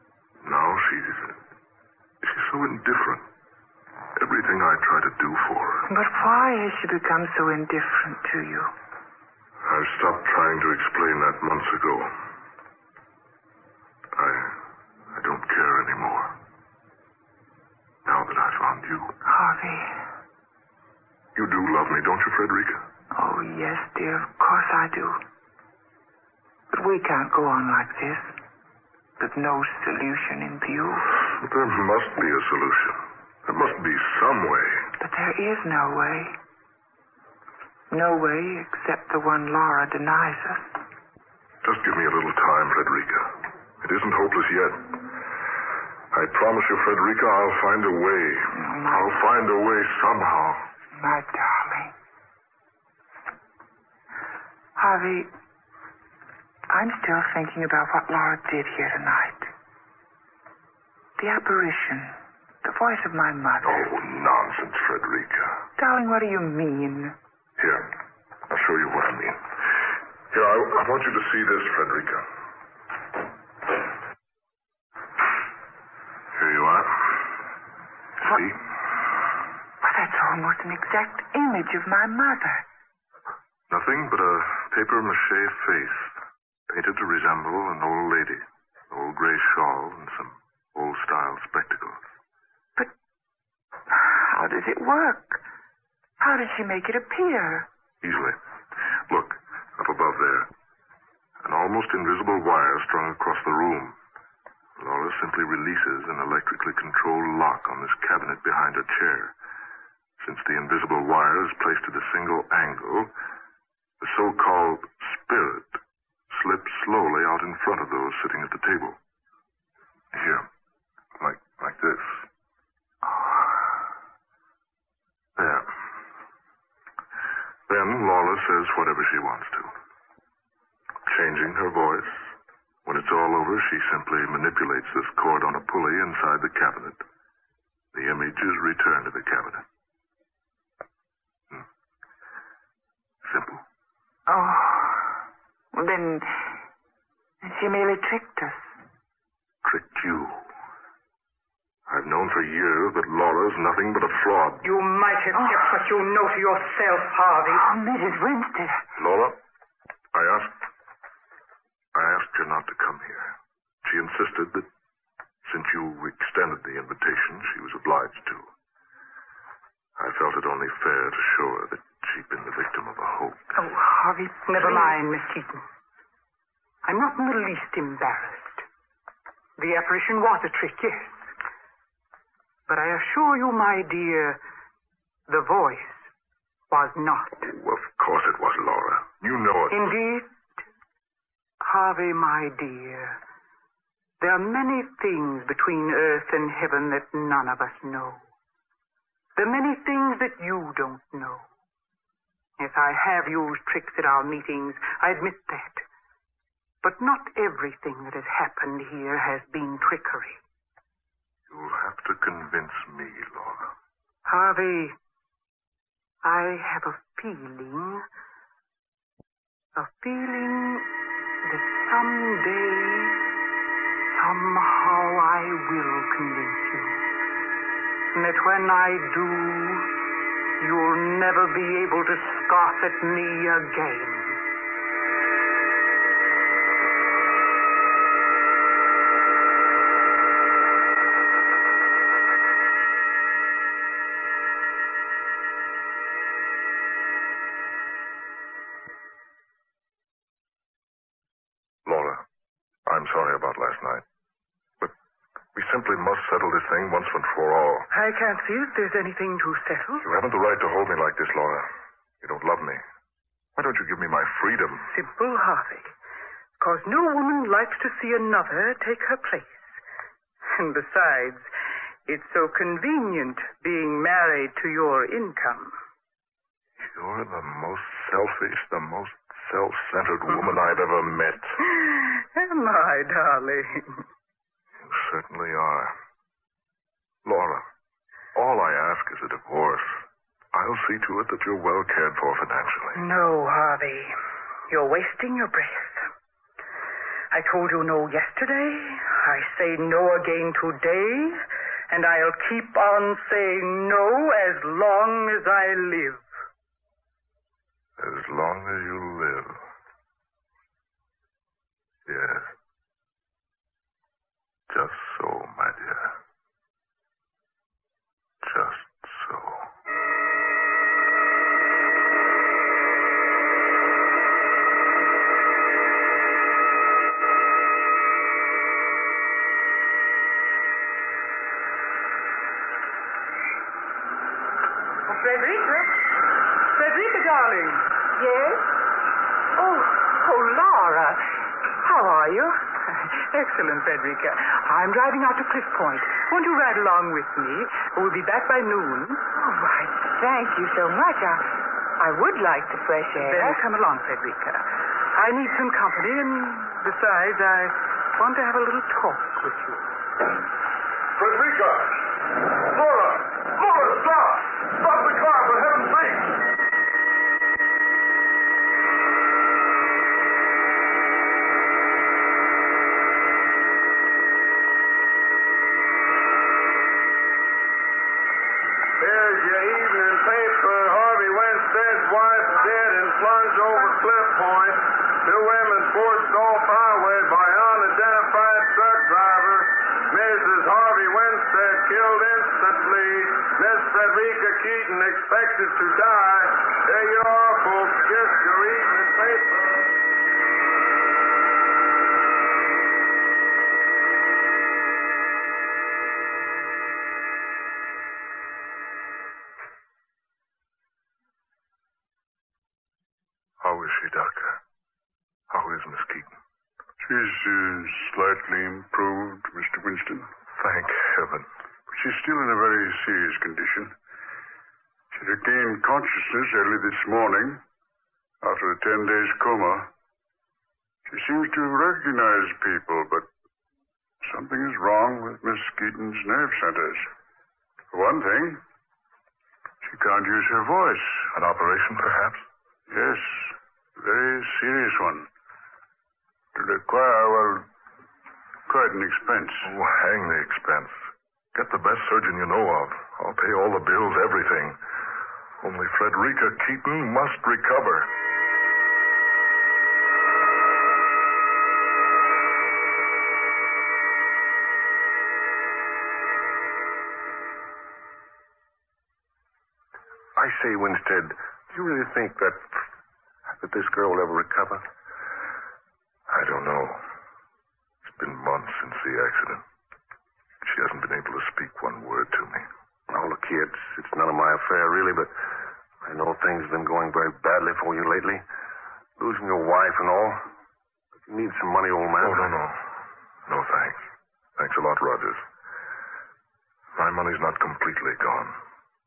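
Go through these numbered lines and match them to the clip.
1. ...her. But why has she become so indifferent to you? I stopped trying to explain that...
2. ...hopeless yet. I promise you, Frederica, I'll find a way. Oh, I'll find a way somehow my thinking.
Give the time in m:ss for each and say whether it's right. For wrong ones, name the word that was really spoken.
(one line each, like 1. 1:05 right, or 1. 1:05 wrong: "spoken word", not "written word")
1. 0:05 right
2. 0:44 wrong: "darling", not "thinking".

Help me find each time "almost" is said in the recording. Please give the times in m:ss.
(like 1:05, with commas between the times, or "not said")
1:20, 1:41.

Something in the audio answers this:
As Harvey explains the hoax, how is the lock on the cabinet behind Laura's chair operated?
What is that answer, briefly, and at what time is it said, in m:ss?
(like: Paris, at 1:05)
electrically controlled, at 1:46.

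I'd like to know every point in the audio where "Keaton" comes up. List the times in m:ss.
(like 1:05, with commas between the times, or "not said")
2:55, 6:56, 7:15, 7:36.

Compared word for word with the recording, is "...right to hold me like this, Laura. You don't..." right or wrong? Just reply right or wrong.
right.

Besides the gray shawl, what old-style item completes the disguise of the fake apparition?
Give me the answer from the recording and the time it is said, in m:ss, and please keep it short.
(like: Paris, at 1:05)
spectacles, at 1:31.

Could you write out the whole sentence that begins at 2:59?
The apparition was a trick, yes.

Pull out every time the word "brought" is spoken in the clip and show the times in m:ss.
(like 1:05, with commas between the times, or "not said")
not said.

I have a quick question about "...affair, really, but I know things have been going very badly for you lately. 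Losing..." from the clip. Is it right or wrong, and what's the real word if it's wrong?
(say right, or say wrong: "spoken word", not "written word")
right.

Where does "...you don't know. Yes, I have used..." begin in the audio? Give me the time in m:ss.
3:20.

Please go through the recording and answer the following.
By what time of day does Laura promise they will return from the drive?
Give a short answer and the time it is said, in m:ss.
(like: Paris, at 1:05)
noon, at 5:48.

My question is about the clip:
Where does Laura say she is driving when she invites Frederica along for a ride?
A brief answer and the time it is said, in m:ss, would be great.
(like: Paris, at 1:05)
Cliff Point, at 5:45.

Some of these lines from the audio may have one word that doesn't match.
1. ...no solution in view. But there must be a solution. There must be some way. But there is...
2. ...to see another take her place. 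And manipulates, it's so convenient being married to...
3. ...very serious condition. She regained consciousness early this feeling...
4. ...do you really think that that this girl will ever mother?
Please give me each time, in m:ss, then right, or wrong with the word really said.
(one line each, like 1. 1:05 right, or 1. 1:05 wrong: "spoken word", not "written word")
1. 0:29 right
2. 4:27 wrong: "besides", not "manipulates"
3. 7:02 wrong: "morning", not "feeling"
4. 7:51 wrong: "recover", not "mother".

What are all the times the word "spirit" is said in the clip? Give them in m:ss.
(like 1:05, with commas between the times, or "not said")
1:55.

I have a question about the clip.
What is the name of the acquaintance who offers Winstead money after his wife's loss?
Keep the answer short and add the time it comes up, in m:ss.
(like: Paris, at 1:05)
Rogers, at 8:15.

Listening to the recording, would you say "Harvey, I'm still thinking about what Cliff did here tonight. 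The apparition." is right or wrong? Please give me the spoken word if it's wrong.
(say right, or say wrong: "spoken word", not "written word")
wrong: "Laura", not "Cliff".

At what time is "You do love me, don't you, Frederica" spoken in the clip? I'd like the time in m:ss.
0:21.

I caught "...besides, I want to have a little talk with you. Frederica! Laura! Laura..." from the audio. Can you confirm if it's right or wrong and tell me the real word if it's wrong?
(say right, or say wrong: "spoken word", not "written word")
right.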